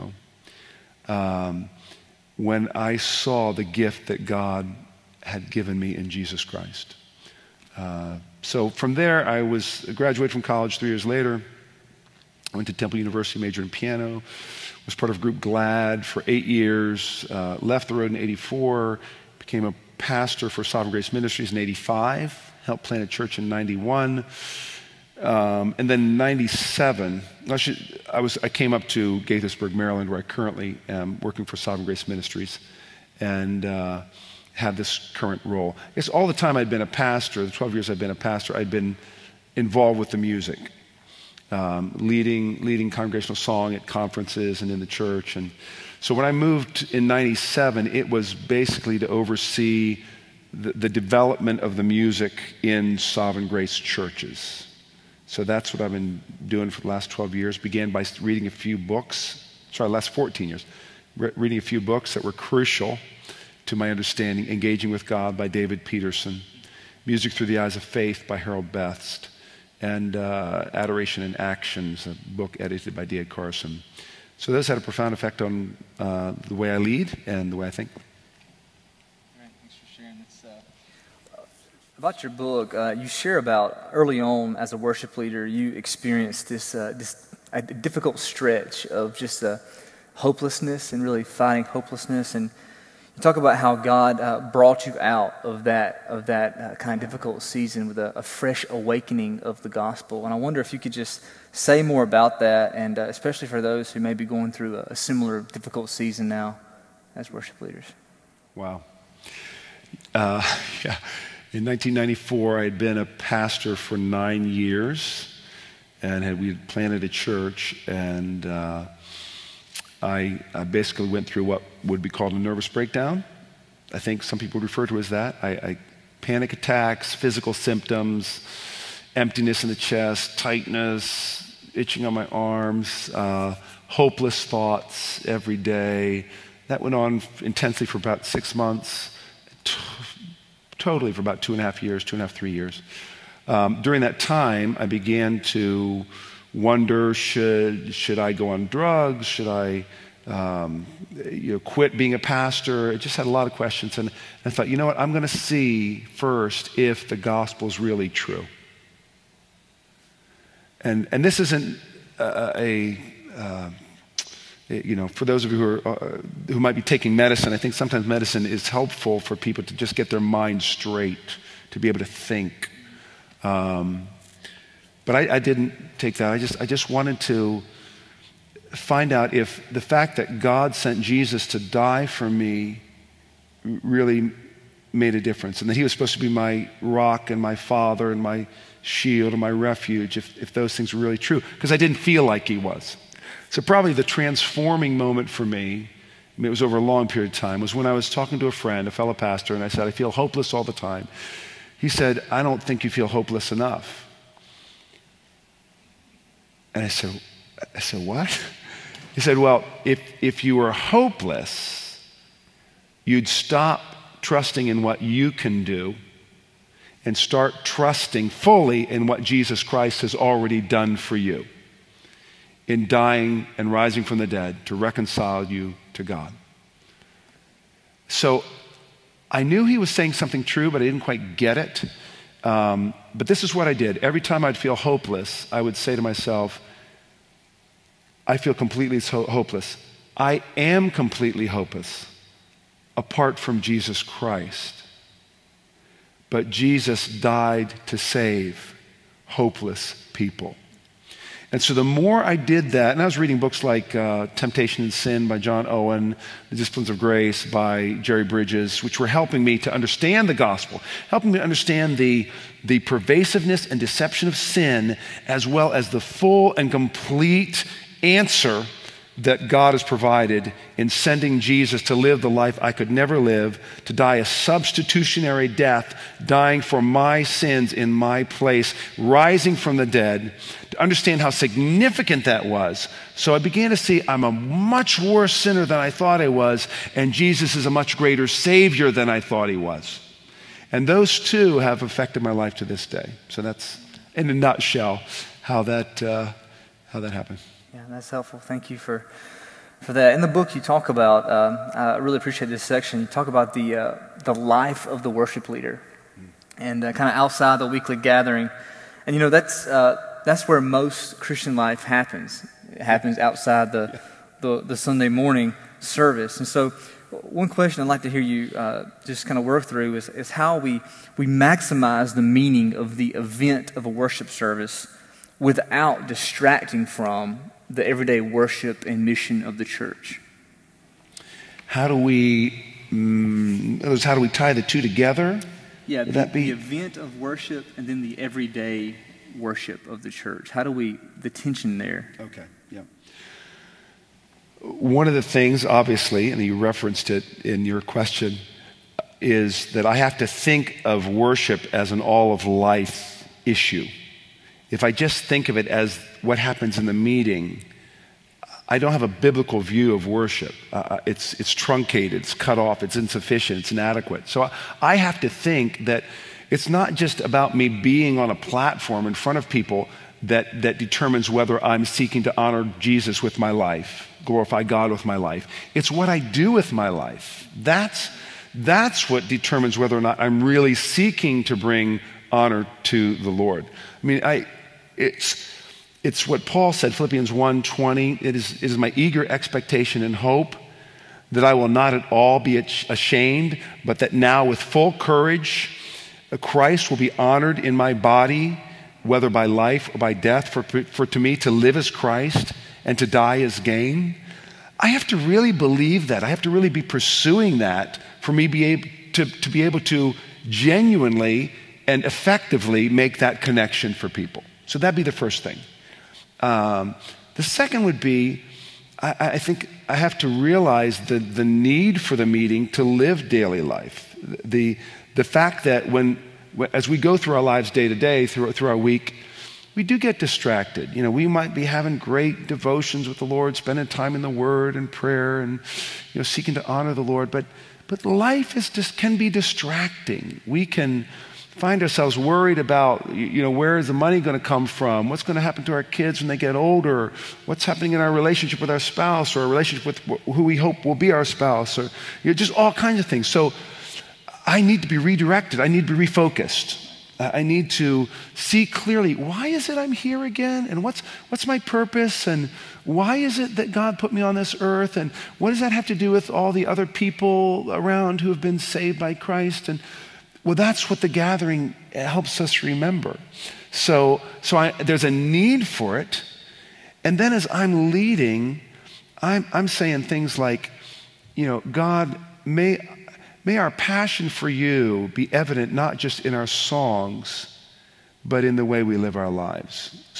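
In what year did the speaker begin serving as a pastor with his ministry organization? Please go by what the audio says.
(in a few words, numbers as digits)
1985.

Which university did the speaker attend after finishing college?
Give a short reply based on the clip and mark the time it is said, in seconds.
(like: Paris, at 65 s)
Temple University, at 12 s.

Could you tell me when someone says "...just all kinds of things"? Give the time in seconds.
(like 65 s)
452 s.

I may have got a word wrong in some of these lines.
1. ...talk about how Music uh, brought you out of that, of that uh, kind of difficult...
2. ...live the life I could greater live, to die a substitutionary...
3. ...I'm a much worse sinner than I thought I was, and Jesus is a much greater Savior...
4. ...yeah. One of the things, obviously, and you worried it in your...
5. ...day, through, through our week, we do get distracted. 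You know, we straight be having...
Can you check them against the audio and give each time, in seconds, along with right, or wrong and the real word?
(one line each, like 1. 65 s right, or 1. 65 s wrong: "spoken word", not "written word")
1. 93 s wrong: "God", not "Music"
2. 271 s wrong: "never", not "greater"
3. 284 s right
4. 342 s wrong: "referenced", not "worried"
5. 427 s wrong: "might", not "straight".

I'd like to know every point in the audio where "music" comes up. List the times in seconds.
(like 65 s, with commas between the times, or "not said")
40 s, 51 s, 67 s.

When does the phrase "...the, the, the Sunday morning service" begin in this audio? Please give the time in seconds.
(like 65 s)
313 s.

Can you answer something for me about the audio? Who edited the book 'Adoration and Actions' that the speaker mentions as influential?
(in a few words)
David Carson.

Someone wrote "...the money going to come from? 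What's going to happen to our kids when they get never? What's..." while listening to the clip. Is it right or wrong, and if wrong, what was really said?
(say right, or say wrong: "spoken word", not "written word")
wrong: "older", not "never".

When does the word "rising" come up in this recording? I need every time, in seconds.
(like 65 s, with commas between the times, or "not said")
223 s, 278 s.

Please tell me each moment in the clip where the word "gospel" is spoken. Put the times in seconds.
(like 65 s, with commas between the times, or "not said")
99 s, 157 s, 260 s.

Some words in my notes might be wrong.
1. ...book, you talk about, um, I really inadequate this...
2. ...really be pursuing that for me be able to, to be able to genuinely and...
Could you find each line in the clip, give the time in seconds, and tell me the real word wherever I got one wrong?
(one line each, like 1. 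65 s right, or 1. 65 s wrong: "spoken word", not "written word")
1. 300 s wrong: "appreciate", not "inadequate"
2. 406 s right.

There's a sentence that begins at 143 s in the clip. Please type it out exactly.
Um, during that time, I began to wonder should, should I go on drugs?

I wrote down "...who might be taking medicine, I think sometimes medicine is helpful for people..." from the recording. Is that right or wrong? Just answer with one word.
right.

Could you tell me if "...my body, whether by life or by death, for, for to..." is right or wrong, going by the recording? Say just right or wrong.
right.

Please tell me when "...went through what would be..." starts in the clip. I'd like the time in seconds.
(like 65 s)
121 s.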